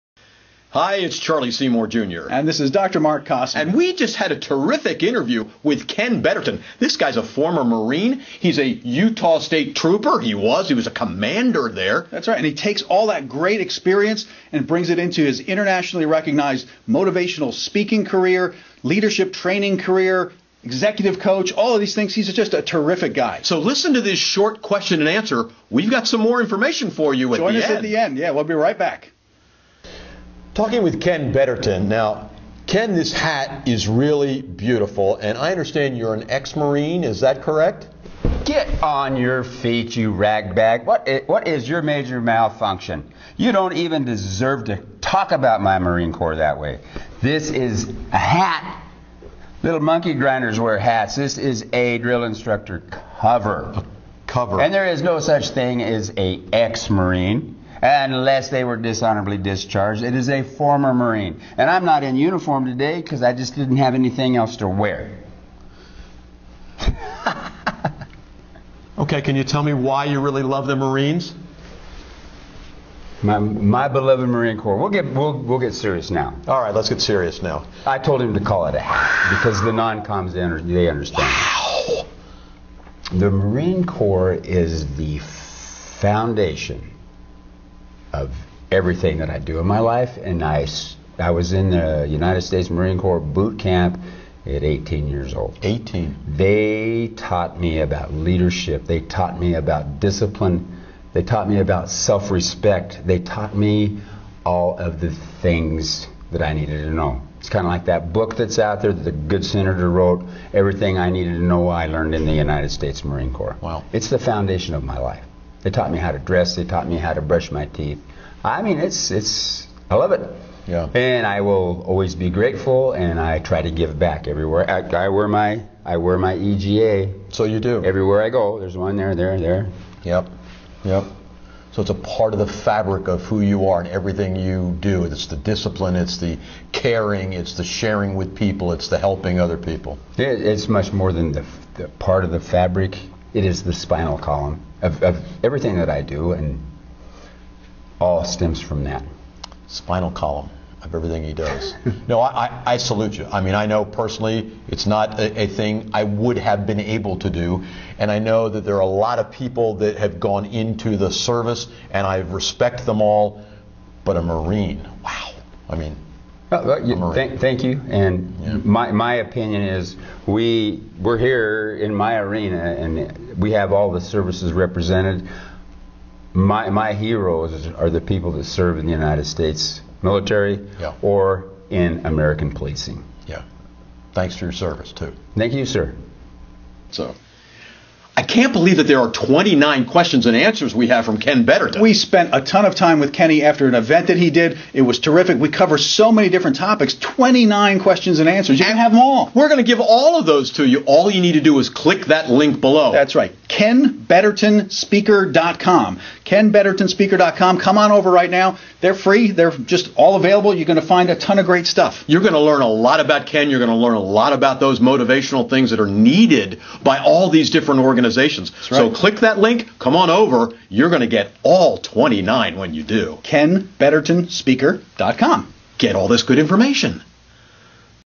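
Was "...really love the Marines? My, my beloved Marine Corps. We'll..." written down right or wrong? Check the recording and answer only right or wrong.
right.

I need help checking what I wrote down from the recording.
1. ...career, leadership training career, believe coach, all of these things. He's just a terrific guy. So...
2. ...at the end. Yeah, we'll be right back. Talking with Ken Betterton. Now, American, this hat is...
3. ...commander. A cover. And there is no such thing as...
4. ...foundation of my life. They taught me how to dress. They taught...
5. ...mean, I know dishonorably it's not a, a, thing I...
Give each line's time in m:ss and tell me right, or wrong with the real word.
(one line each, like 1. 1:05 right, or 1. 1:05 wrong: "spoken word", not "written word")
1. 0:18 wrong: "executive", not "believe"
2. 0:27 wrong: "Ken", not "American"
3. 0:53 wrong: "cover", not "commander"
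4. 1:54 right
5. 2:33 wrong: "personally", not "dishonorably".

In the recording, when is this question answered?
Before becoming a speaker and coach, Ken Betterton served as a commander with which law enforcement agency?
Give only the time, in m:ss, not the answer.
0:08.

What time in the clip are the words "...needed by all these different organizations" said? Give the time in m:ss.
3:35.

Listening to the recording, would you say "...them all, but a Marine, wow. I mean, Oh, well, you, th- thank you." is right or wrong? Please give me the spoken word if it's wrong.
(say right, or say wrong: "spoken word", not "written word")
right.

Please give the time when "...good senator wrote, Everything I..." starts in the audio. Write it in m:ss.
1:49.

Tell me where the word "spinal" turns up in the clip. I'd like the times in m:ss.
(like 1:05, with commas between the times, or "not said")
2:23, 2:29.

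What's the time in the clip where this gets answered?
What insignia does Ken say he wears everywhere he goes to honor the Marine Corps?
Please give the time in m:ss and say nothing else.
2:06.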